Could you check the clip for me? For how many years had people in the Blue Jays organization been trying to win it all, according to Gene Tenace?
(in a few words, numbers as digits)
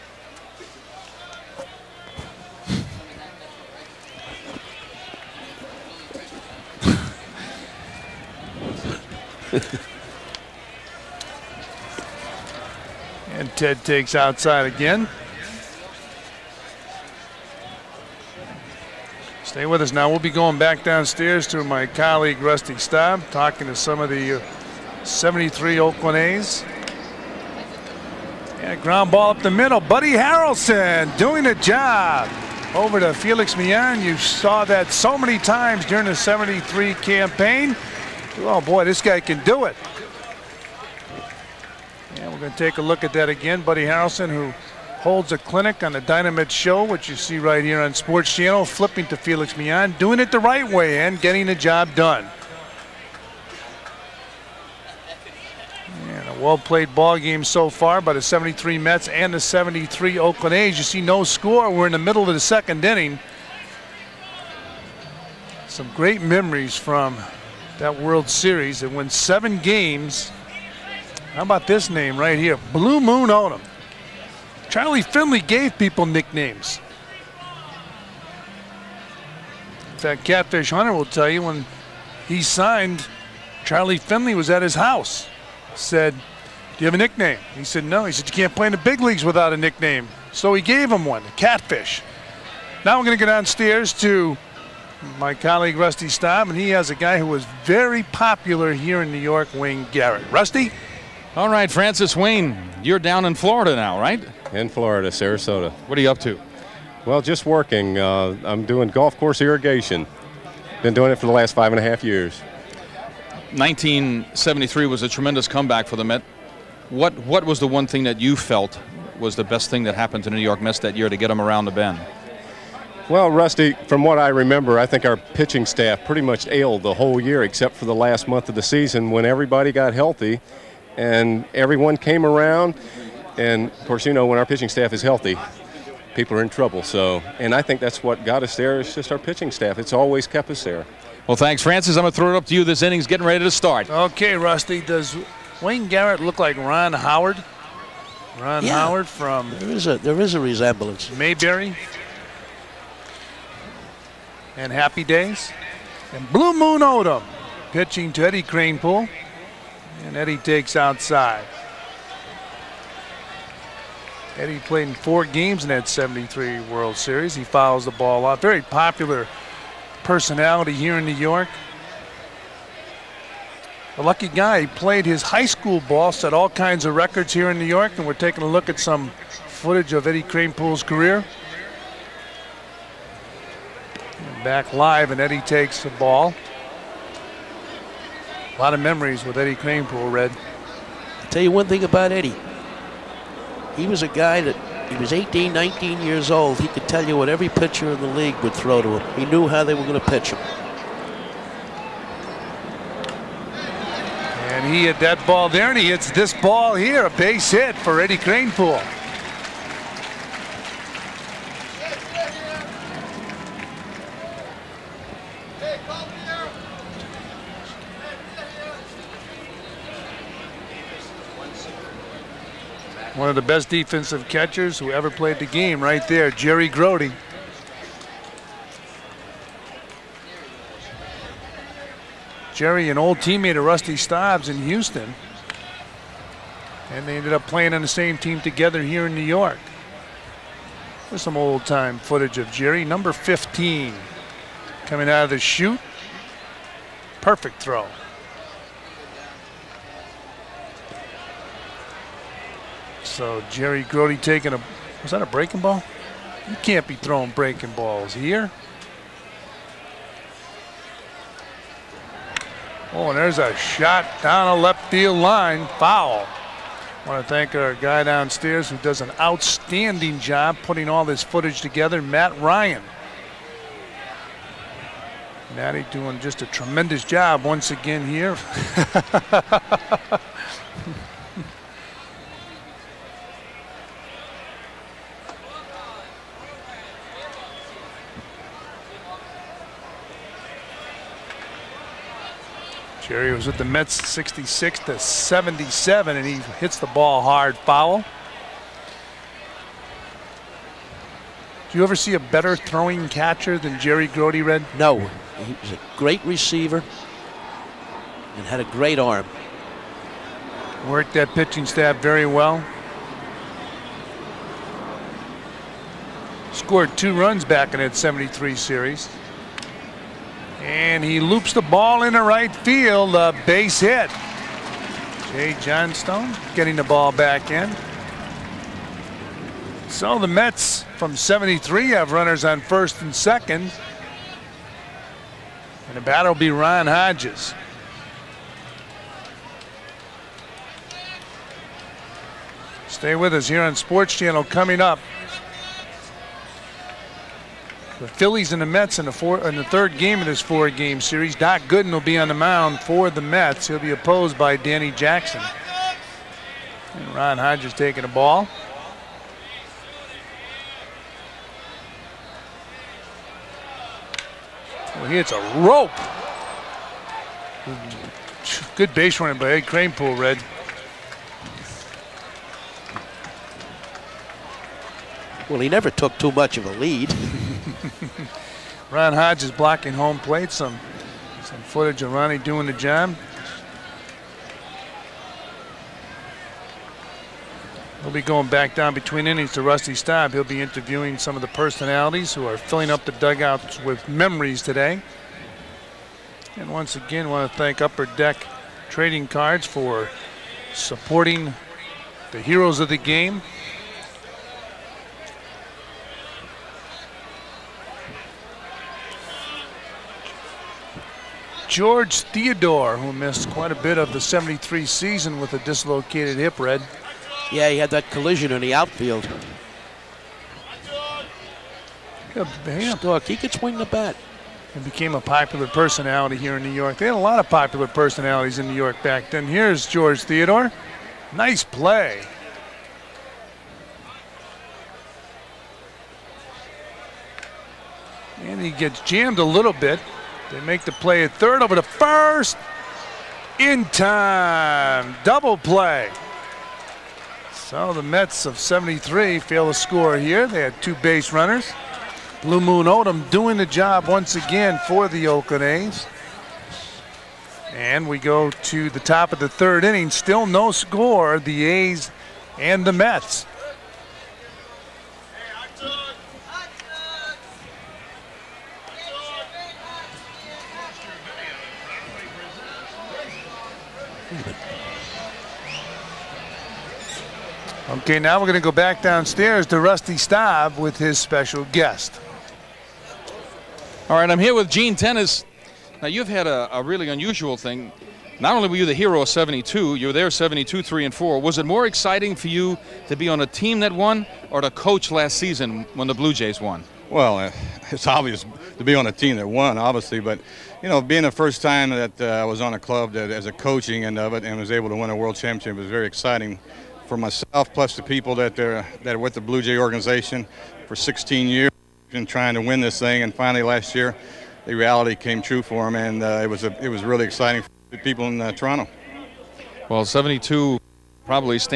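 16.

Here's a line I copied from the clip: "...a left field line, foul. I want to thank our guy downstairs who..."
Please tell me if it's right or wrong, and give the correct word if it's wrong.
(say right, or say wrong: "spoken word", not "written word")
right.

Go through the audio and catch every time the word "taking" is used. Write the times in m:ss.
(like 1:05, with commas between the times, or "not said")
2:58, 4:14, 5:57.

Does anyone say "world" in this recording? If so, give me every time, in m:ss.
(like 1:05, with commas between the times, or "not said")
1:07, 2:46, 8:25.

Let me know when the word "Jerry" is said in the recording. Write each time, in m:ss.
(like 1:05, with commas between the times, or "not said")
3:46, 3:52, 4:02, 4:13, 4:53, 5:03.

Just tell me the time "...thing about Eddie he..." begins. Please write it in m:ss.
3:11.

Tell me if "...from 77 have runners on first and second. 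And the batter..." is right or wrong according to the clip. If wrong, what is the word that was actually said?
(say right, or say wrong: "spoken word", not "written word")
wrong: "73", not "77".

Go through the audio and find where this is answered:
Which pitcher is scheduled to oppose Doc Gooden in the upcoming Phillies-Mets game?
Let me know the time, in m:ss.
5:54.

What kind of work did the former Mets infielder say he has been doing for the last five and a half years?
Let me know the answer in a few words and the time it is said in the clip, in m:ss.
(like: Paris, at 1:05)
Golf course irrigation, at 1:48.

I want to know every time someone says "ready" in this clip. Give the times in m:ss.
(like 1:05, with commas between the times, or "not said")
2:23.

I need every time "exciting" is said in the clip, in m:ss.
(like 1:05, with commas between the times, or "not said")
8:11, 8:26, 8:37.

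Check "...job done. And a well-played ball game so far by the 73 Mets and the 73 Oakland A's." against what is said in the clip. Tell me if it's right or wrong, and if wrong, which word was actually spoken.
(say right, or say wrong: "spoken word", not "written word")
right.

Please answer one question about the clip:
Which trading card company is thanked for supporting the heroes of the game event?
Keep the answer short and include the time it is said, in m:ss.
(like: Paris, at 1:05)
Upper Deck, at 6:37.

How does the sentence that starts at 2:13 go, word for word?
And of course, you know, when our pitching staff is healthy, people are in trouble.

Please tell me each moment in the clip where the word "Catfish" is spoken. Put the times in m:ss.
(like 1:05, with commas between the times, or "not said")
1:20, 1:31.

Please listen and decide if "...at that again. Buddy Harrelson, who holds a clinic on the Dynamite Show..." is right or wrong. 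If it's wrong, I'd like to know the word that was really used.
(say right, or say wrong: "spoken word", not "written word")
right.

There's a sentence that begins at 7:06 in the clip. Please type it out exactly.
They had a lot of popular personalities in New York back then.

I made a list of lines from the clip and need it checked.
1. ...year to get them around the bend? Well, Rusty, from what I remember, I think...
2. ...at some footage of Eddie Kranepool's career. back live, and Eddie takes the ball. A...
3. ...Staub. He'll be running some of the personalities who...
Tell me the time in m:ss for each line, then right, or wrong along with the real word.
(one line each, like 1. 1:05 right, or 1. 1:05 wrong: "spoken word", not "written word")
1. 2:00 right
2. 2:58 right
3. 6:29 wrong: "interviewing", not "running".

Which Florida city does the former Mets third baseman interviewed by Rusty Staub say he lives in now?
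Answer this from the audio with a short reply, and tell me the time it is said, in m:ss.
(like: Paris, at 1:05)
Sarasota, at 1:45.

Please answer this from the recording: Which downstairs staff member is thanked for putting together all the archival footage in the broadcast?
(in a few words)
Matt Ryan.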